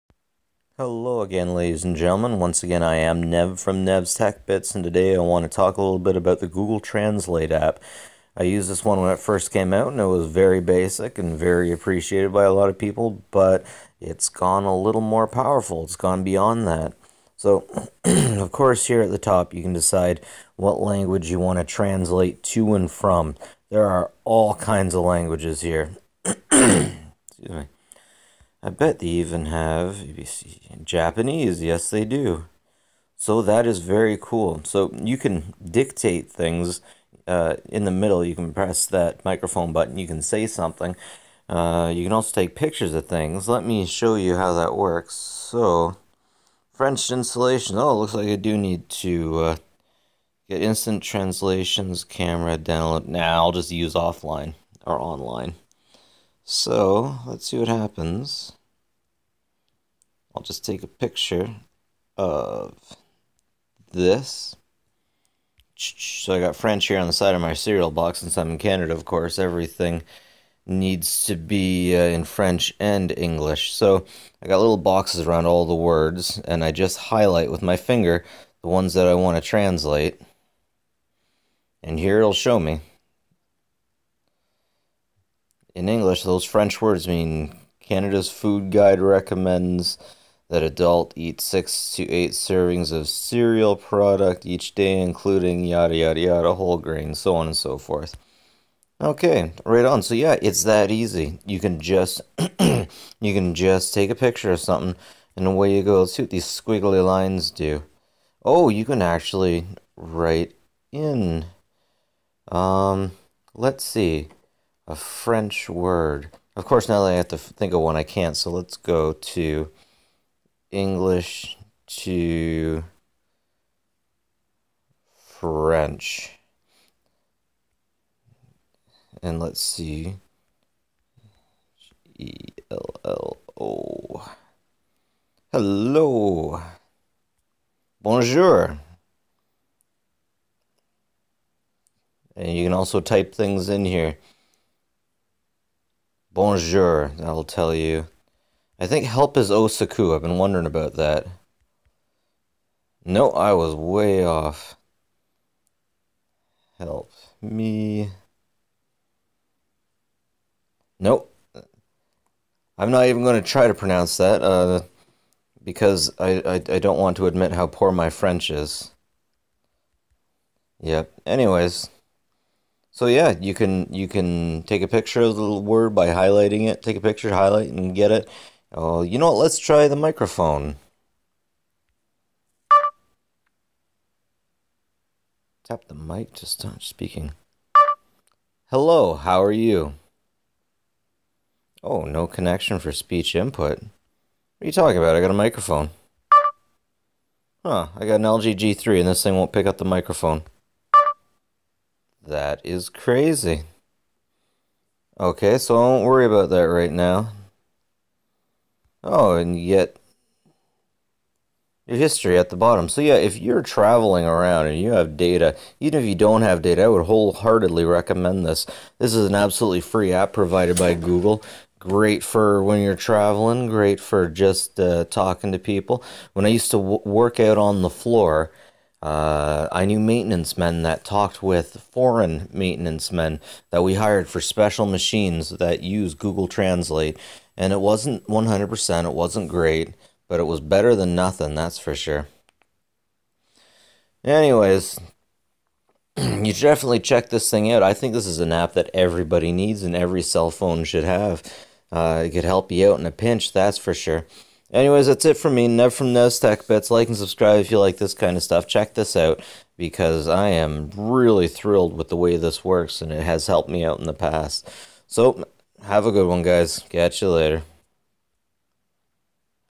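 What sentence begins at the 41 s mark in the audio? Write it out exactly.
Uh, you can also take pictures of things.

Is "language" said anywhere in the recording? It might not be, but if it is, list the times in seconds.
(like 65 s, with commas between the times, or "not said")
20 s, 25 s.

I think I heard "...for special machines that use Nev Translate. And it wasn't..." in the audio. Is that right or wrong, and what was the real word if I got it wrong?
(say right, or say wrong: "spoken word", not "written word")
wrong: "Google", not "Nev".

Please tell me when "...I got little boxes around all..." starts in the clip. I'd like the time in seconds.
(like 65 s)
74 s.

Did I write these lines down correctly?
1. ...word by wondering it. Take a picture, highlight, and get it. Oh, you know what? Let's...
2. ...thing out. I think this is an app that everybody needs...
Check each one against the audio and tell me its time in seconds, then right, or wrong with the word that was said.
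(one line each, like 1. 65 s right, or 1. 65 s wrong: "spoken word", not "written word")
1. 175 s wrong: "highlighting", not "wondering"
2. 247 s right.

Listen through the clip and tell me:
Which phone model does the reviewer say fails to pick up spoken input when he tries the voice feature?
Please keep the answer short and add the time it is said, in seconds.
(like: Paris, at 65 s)
LG G3, at 198 s.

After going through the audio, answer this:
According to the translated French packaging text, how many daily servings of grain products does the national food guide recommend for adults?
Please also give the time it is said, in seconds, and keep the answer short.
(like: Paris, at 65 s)
6 to 8, at 91 s.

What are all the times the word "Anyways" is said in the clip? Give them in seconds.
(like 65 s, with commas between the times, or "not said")
171 s, 244 s, 254 s.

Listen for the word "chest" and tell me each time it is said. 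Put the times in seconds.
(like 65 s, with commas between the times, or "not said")
not said.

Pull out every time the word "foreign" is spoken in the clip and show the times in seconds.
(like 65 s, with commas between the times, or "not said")
231 s.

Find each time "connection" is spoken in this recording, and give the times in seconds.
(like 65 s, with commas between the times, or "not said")
192 s.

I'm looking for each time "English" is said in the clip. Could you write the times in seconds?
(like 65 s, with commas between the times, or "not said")
73 s, 85 s, 120 s.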